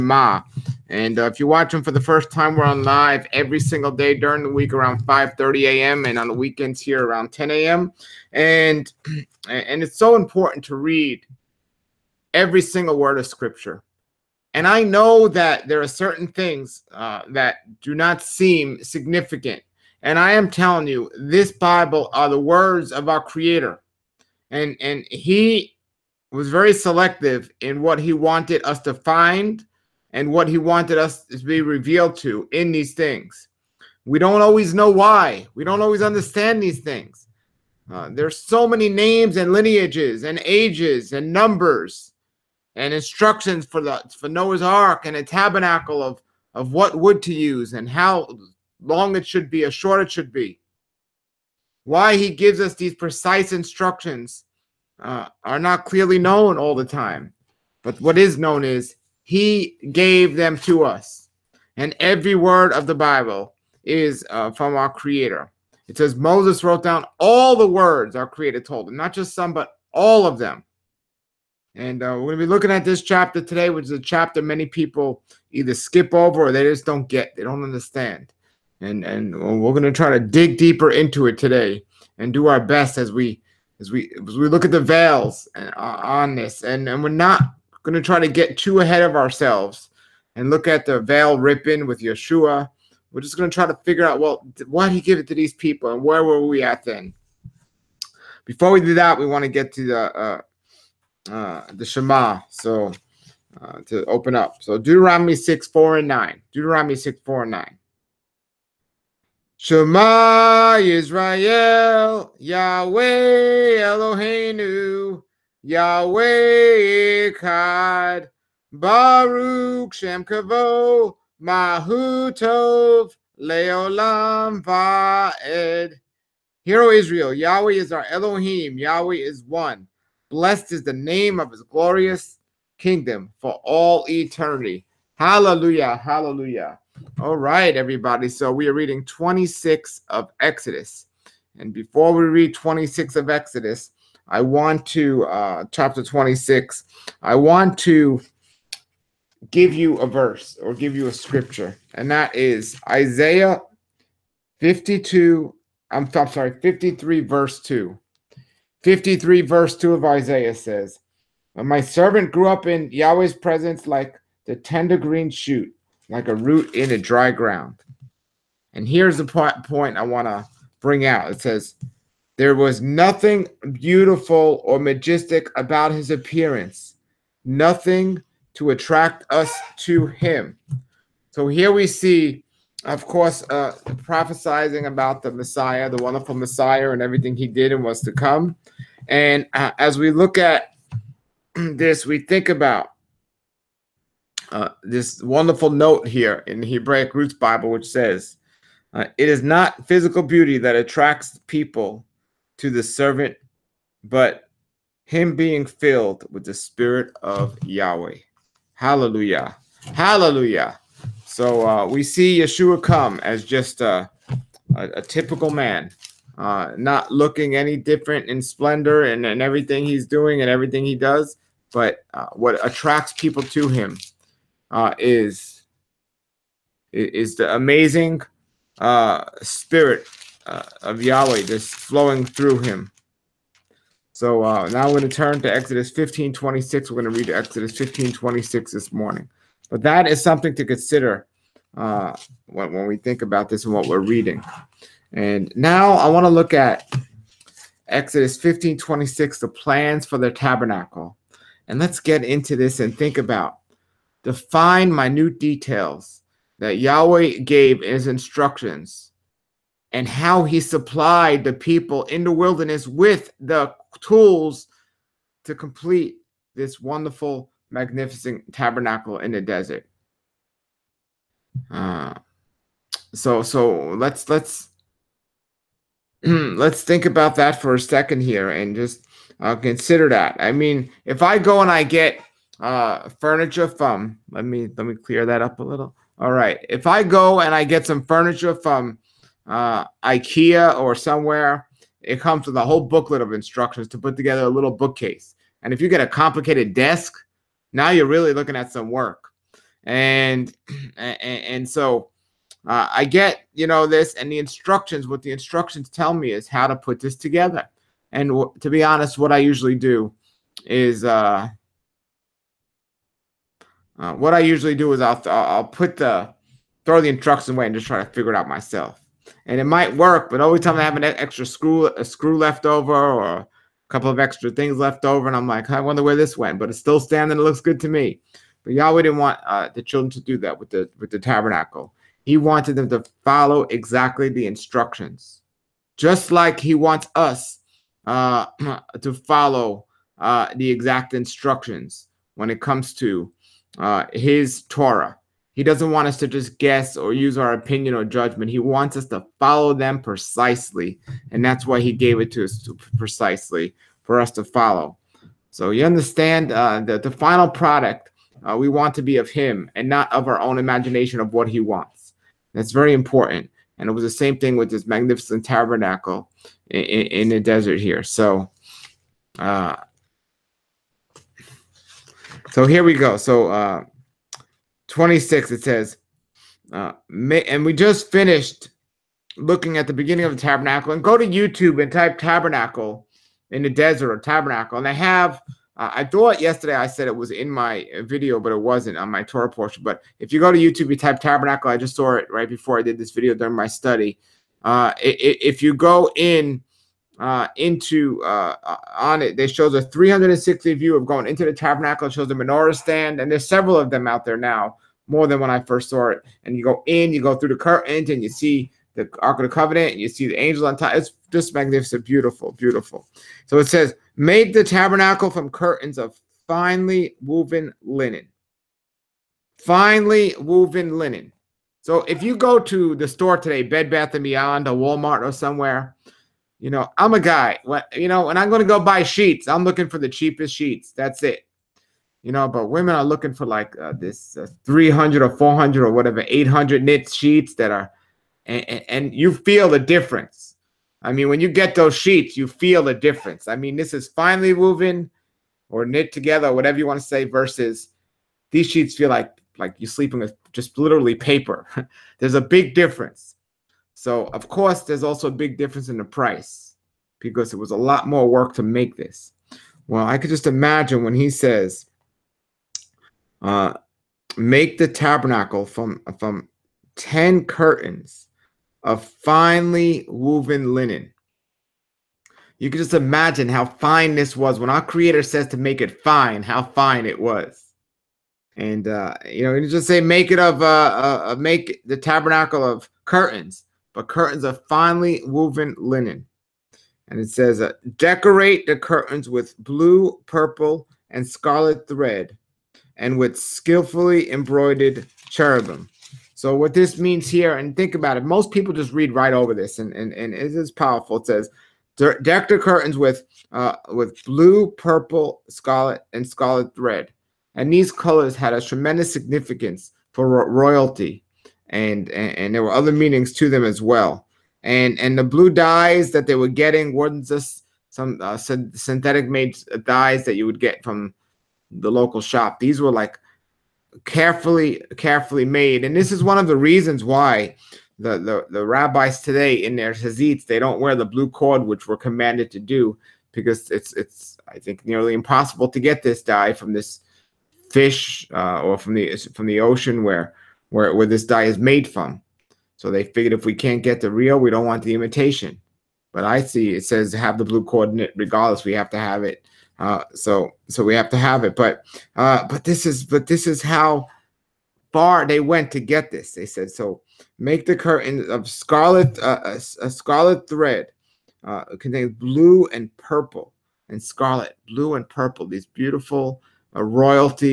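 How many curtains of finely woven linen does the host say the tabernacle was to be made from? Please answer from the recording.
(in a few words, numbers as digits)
10.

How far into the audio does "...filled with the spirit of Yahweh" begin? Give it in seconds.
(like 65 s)
205 s.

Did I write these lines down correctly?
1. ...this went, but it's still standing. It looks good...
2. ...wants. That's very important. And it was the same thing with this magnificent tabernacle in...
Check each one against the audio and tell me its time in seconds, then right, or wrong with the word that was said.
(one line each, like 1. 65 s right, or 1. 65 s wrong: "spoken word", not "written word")
1. 326 s right
2. 361 s right.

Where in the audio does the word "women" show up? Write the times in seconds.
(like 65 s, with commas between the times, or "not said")
432 s.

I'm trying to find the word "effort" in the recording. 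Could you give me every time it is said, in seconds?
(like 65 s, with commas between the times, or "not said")
not said.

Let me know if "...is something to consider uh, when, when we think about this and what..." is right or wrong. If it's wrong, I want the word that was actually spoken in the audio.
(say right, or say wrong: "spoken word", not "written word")
right.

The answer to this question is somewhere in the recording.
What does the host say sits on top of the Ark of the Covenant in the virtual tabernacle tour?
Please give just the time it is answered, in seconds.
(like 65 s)
410 s.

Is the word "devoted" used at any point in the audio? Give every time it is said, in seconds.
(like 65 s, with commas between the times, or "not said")
not said.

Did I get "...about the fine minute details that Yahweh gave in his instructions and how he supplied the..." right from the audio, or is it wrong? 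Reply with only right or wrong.
right.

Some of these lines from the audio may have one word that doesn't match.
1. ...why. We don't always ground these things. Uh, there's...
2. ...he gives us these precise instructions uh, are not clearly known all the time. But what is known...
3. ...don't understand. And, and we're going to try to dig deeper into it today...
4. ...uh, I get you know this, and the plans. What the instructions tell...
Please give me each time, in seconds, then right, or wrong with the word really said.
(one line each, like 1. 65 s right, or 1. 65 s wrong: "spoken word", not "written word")
1. 34 s wrong: "understand", not "ground"
2. 52 s right
3. 77 s right
4. 302 s wrong: "instructions", not "plans".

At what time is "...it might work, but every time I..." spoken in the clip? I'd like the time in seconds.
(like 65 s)
319 s.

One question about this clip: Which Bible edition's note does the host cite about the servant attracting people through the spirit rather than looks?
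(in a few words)
Hebraic Roots Bible.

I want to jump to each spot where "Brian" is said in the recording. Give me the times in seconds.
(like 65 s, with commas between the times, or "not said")
not said.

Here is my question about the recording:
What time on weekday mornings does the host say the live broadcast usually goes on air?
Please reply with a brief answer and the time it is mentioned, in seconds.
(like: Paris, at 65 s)
5:30 a.m., at 5 s.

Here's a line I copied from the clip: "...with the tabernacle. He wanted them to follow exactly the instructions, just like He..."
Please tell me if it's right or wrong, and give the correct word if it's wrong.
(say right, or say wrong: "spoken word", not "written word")
right.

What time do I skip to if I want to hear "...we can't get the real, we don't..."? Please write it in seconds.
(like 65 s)
543 s.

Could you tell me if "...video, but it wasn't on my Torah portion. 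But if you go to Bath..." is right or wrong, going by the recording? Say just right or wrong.
wrong.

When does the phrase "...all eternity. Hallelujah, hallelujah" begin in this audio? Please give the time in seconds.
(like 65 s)
133 s.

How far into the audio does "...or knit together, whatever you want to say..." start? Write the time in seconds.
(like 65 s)
445 s.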